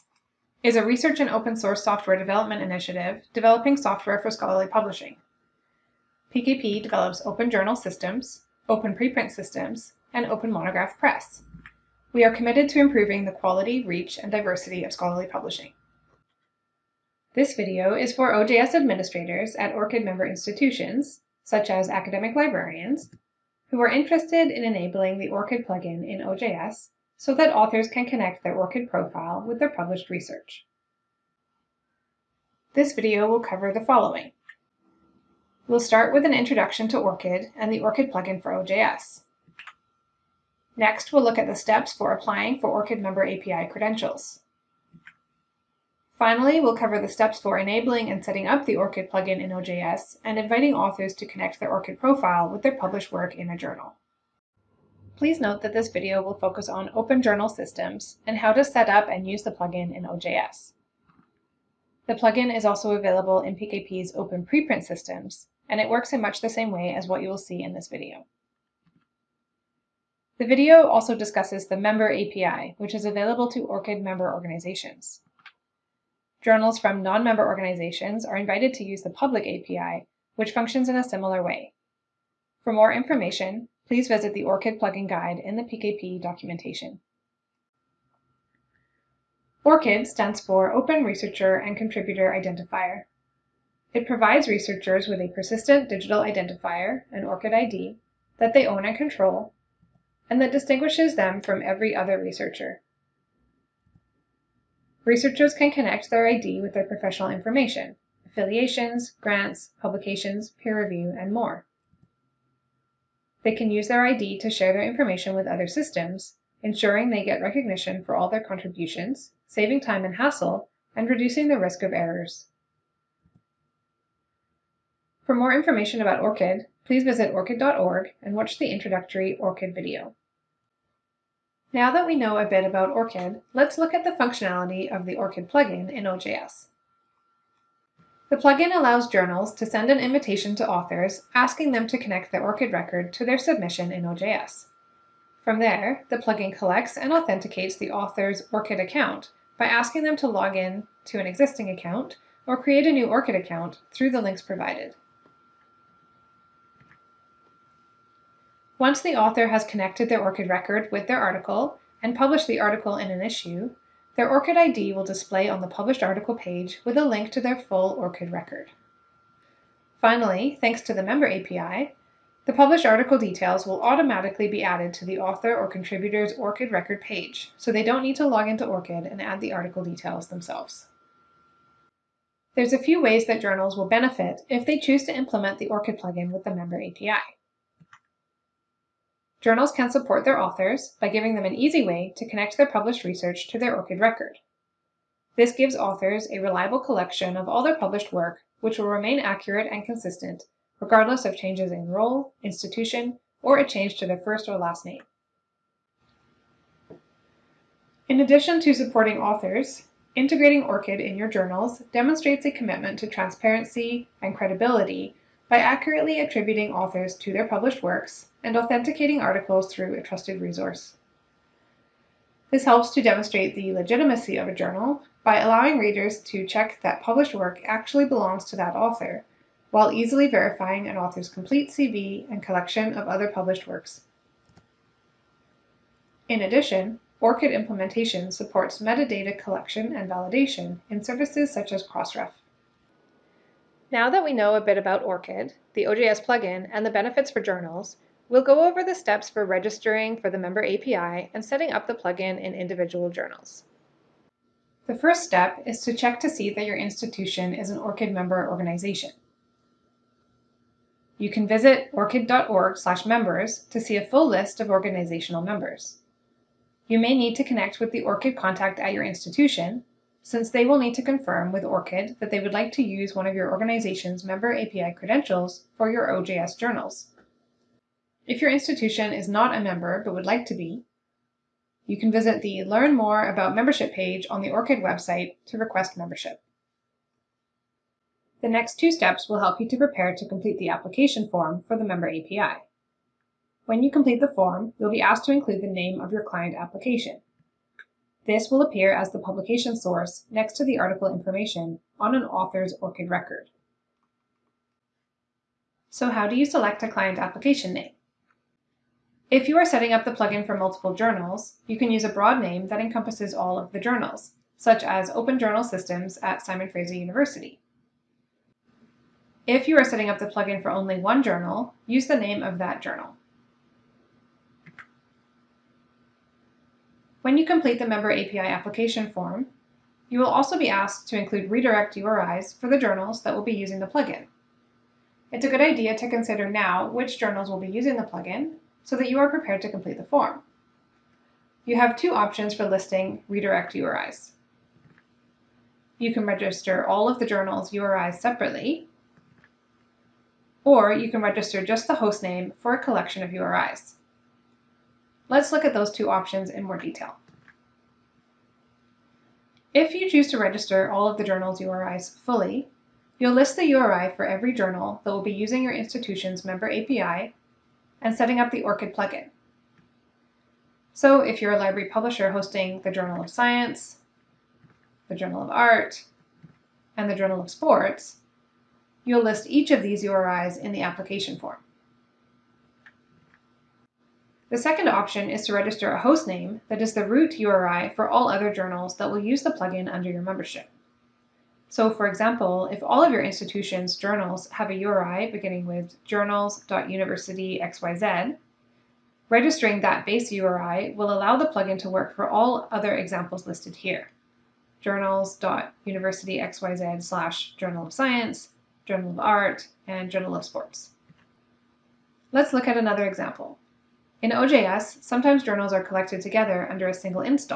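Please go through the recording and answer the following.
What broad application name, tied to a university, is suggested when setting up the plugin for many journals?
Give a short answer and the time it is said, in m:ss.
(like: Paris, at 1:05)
Open Journal Systems at Simon Fraser University, at 5:15.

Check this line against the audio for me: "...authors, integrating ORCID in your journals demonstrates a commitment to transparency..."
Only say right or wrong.
right.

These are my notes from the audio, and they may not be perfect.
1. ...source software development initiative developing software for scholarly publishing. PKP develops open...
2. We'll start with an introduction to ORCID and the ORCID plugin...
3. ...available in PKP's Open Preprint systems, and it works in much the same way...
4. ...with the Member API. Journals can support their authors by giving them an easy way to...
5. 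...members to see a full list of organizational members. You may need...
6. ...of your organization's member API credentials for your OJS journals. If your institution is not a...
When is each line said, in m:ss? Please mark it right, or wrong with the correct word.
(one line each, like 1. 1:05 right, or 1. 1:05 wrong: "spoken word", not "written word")
1. 0:01 right
2. 0:35 right
3. 1:02 right
4. 3:06 right
5. 4:23 right
6. 4:33 right.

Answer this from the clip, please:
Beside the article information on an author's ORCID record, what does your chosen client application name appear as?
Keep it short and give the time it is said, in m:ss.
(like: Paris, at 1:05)
publication source, at 4:59.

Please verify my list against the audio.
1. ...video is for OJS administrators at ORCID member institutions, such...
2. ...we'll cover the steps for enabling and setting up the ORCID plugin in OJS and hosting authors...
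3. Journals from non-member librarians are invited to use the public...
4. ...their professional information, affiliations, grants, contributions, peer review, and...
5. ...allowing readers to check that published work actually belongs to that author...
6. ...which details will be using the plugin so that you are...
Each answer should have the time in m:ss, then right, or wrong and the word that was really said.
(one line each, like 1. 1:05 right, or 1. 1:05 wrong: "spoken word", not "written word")
1. 0:17 right
2. 0:46 wrong: "inviting", not "hosting"
3. 1:16 wrong: "organizations", not "librarians"
4. 1:46 wrong: "publications", not "contributions"
5. 3:45 right
6. 5:36 wrong: "journals", not "details".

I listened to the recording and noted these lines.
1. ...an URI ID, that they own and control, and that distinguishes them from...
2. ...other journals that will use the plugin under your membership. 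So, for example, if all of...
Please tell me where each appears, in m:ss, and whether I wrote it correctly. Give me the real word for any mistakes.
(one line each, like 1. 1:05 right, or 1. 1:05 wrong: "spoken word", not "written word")
1. 1:37 wrong: "ORCID", not "URI"
2. 6:28 right.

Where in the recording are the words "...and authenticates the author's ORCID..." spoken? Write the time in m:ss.
2:26.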